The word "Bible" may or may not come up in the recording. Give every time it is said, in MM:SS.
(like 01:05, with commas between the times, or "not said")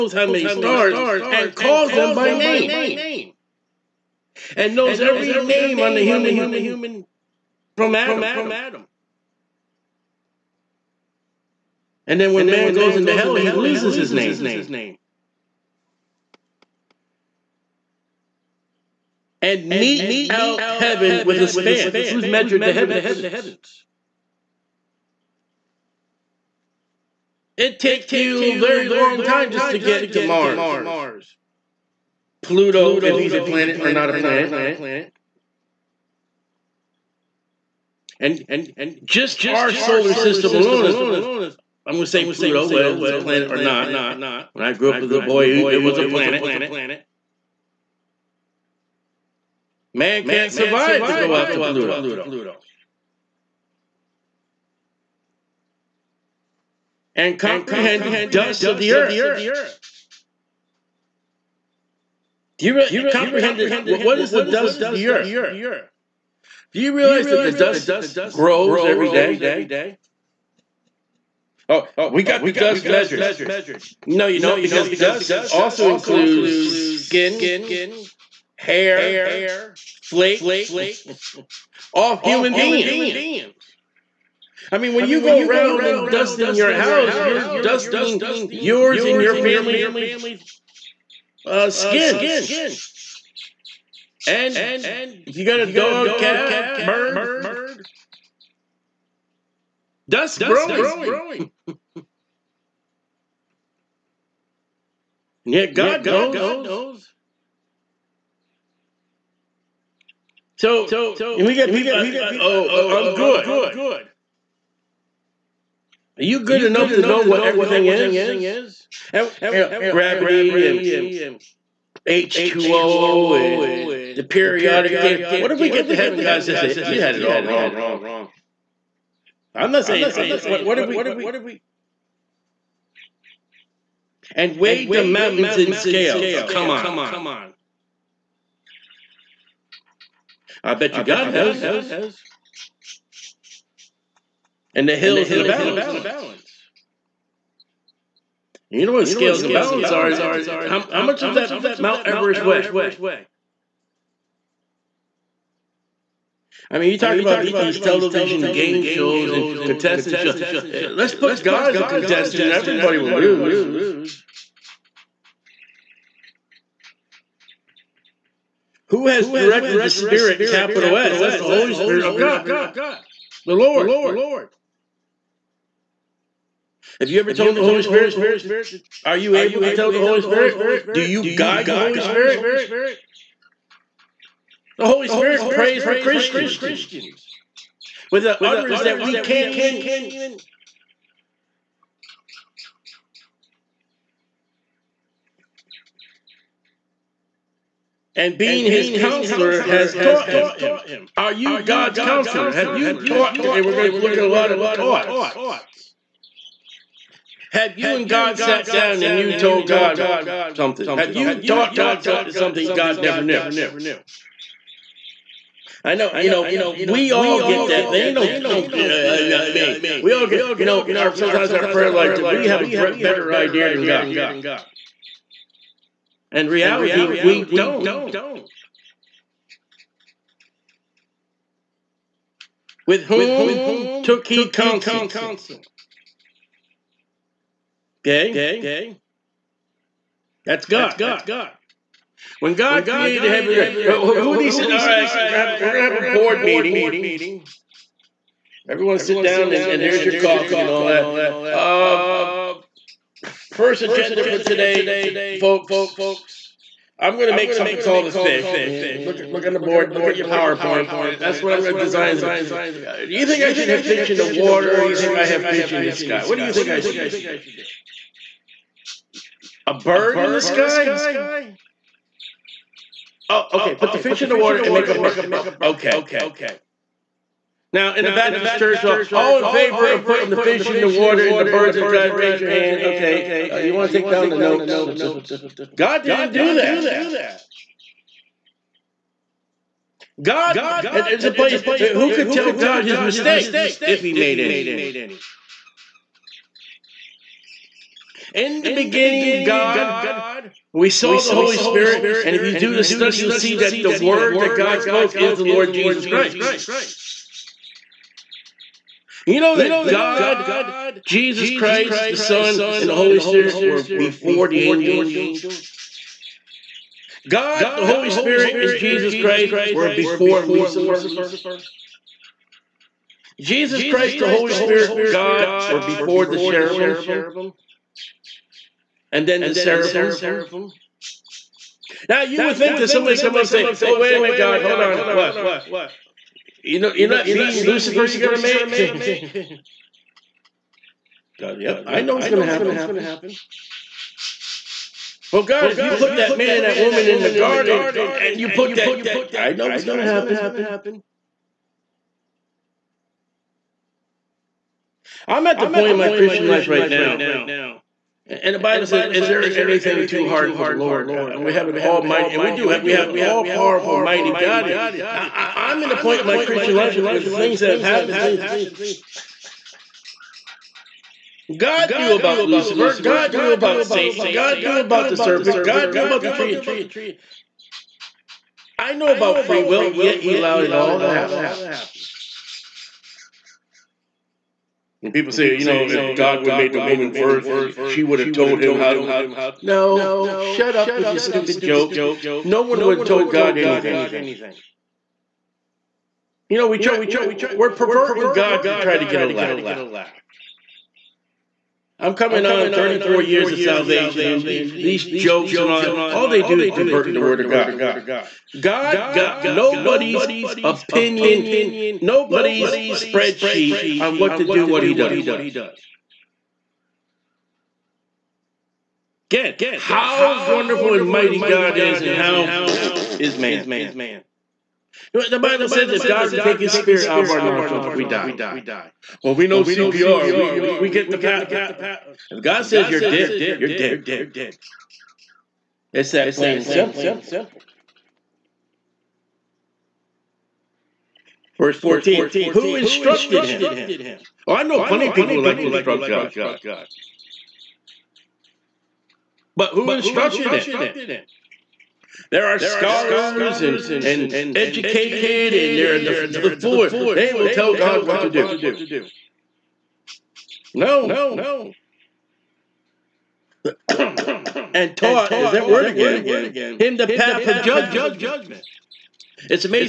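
05:58, 07:05.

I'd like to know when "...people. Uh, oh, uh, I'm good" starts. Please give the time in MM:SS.
01:51.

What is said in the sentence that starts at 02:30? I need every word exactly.
How, how much does that Mount Everest weigh?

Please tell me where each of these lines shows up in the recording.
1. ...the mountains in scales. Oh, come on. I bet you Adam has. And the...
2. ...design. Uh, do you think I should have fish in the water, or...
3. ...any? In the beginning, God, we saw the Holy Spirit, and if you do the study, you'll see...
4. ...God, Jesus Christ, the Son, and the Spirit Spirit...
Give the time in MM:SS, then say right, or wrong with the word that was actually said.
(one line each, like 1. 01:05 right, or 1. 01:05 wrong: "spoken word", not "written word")
1. 02:14 wrong: "God", not "Adam"
2. 04:21 right
3. 04:54 right
4. 05:09 wrong: "Holy", not "Spirit".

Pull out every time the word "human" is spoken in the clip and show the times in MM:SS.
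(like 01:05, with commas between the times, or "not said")
00:06, 01:22.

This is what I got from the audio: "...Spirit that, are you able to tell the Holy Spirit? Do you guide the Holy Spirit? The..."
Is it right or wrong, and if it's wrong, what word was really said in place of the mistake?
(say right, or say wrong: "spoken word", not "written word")
right.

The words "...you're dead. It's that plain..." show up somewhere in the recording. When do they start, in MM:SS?
07:13.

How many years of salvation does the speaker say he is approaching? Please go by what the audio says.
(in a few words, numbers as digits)
34.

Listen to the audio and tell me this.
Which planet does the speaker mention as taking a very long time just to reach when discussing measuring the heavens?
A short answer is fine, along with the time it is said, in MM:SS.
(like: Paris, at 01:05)
Mars, at 00:30.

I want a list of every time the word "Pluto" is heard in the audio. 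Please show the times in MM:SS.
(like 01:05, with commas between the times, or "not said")
00:32, 00:42, 00:51.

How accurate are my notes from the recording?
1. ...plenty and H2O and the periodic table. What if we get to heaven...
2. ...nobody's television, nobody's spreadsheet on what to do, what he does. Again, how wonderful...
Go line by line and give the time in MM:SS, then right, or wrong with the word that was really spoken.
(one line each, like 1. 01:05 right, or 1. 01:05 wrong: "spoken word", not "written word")
1. 01:59 wrong: "gravity", not "plenty"
2. 06:49 wrong: "opinion", not "television".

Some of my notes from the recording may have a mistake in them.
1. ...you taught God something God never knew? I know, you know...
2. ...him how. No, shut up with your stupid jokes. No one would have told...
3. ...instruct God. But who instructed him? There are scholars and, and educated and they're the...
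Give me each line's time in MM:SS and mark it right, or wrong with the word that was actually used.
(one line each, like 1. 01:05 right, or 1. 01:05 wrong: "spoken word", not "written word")
1. 03:31 right
2. 06:28 right
3. 07:25 right.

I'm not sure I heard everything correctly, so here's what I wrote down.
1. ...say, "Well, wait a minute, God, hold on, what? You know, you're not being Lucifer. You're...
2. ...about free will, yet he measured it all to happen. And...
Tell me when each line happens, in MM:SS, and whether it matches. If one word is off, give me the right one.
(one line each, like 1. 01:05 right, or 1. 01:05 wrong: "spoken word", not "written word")
1. 05:33 right
2. 06:19 wrong: "allowed", not "measured".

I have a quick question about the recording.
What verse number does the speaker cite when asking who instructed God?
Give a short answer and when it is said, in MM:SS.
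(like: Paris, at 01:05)
14, at 07:21.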